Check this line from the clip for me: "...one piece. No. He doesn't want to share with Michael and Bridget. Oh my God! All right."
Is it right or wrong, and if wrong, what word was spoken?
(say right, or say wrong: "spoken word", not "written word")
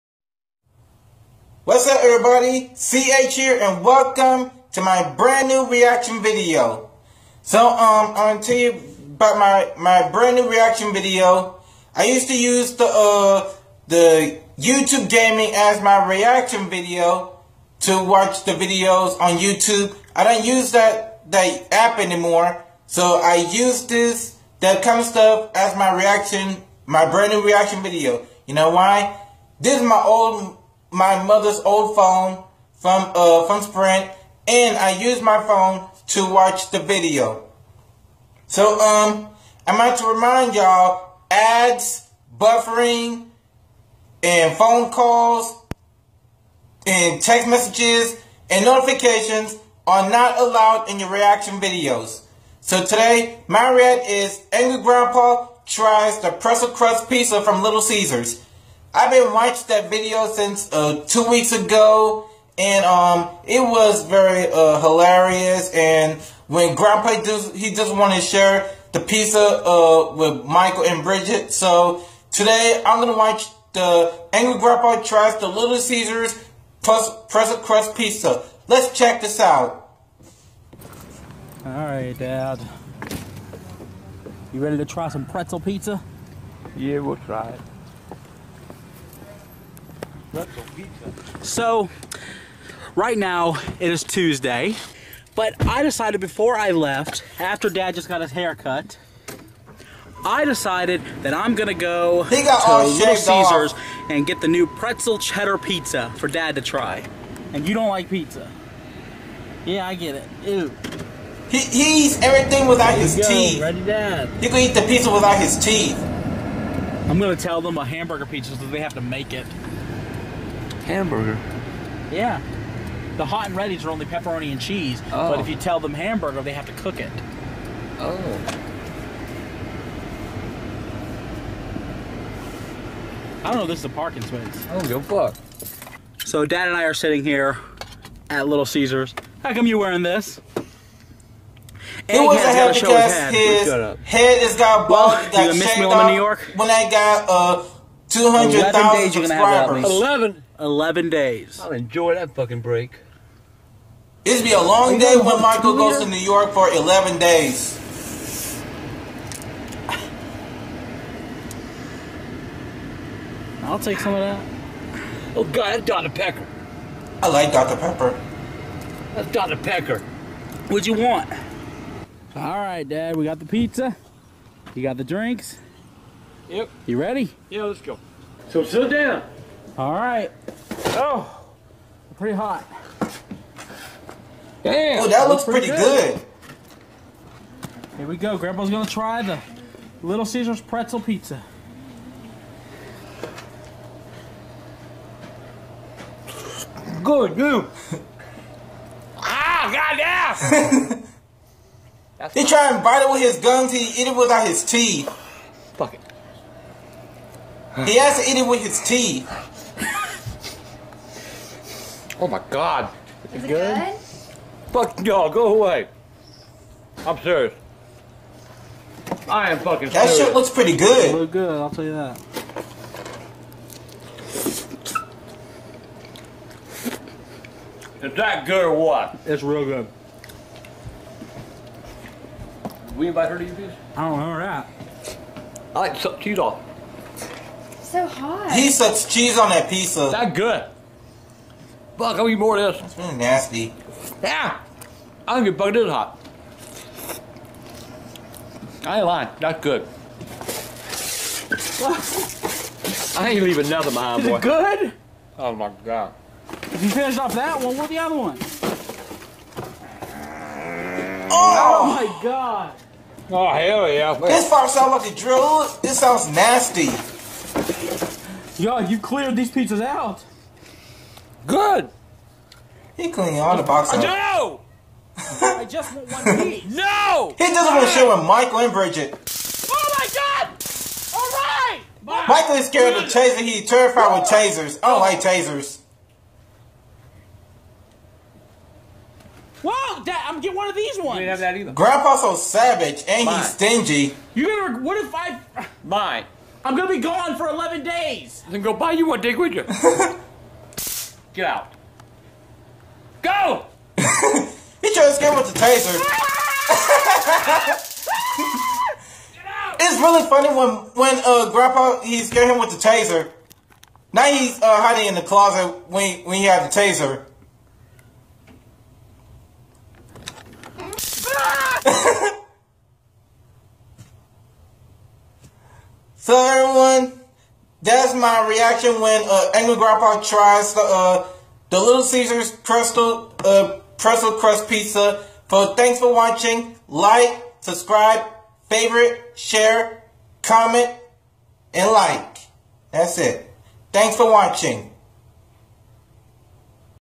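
right.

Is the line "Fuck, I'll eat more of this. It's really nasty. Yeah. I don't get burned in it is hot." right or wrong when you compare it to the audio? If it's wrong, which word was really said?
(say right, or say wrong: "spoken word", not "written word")
right.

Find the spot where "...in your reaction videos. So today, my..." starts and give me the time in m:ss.
0:50.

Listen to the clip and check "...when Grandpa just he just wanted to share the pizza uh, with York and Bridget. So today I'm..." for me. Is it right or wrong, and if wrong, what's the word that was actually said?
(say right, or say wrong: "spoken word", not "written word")
wrong: "Michael", not "York".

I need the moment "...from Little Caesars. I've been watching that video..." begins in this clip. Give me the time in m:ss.
0:57.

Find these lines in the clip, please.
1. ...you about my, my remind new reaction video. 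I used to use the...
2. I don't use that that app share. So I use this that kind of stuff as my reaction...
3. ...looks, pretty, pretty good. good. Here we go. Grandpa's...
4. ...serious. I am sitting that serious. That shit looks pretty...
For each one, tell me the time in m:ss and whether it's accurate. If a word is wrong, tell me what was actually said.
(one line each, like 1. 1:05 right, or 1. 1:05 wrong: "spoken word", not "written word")
1. 0:08 wrong: "brand", not "remind"
2. 0:20 wrong: "anymore", not "share"
3. 3:05 right
4. 3:37 wrong: "fucking", not "sitting".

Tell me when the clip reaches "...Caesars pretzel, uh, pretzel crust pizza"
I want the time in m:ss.
5:32.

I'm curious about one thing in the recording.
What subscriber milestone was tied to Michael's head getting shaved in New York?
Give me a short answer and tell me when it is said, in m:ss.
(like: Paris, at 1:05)
200,000 subscribers, at 2:28.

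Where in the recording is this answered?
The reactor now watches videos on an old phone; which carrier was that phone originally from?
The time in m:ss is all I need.
0:33.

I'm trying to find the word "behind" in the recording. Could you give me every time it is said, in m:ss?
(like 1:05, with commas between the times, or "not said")
4:13.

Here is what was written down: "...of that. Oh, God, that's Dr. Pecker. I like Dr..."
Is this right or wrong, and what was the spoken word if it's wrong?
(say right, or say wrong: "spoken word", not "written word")
right.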